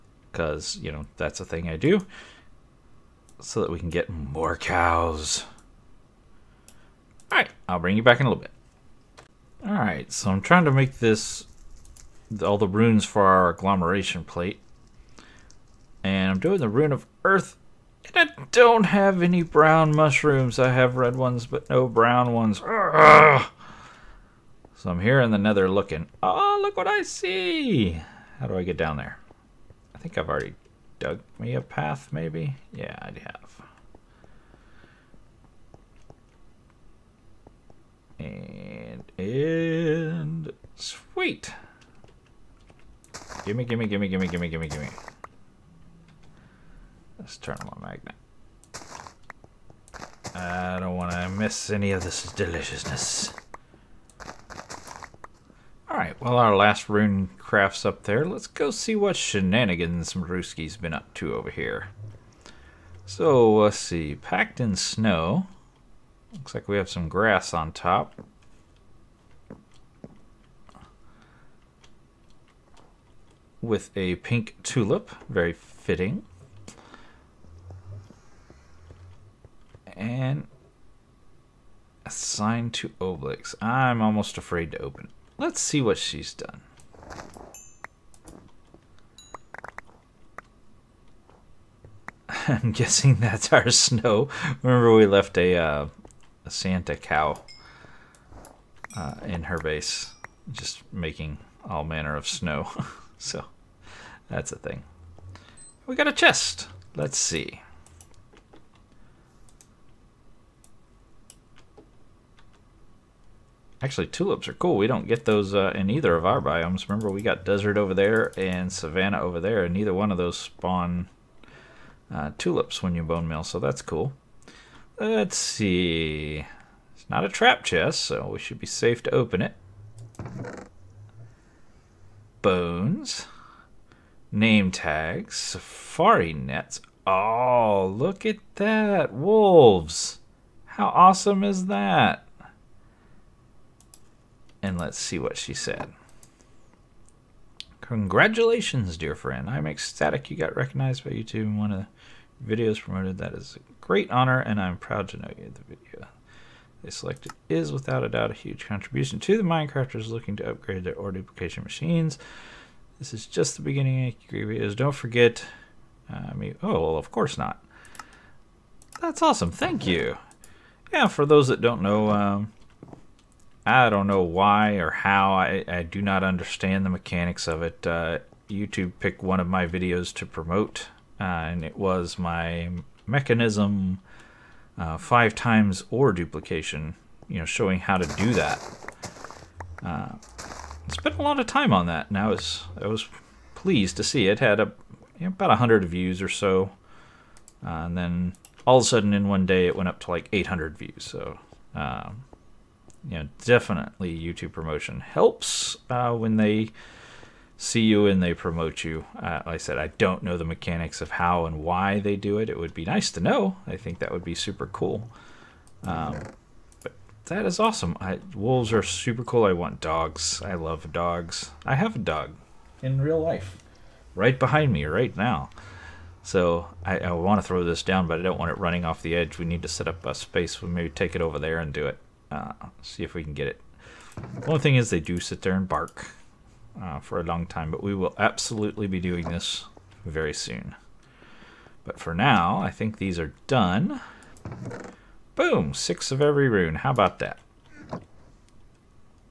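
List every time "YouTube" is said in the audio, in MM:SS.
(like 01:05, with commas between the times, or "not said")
02:31, 02:58, 03:24.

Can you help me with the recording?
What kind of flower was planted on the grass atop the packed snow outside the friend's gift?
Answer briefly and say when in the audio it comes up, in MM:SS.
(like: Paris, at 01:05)
pink tulip, at 01:14.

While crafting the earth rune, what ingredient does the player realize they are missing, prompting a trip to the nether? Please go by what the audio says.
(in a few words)
brown mushrooms.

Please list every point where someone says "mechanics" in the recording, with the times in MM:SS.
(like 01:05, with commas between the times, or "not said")
02:56, 03:30.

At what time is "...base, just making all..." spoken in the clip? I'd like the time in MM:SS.
01:39.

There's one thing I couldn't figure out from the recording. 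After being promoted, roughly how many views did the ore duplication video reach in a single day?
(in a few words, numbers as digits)
800.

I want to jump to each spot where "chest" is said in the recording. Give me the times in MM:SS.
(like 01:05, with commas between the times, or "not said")
01:46, 02:07.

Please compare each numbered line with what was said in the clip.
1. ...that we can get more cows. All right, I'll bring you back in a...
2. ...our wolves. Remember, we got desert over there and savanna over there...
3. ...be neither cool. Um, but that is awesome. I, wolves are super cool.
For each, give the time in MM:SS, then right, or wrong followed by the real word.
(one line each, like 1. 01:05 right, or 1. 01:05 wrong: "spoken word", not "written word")
1. 00:03 right
2. 01:56 wrong: "biomes", not "wolves"
3. 03:34 wrong: "super", not "neither".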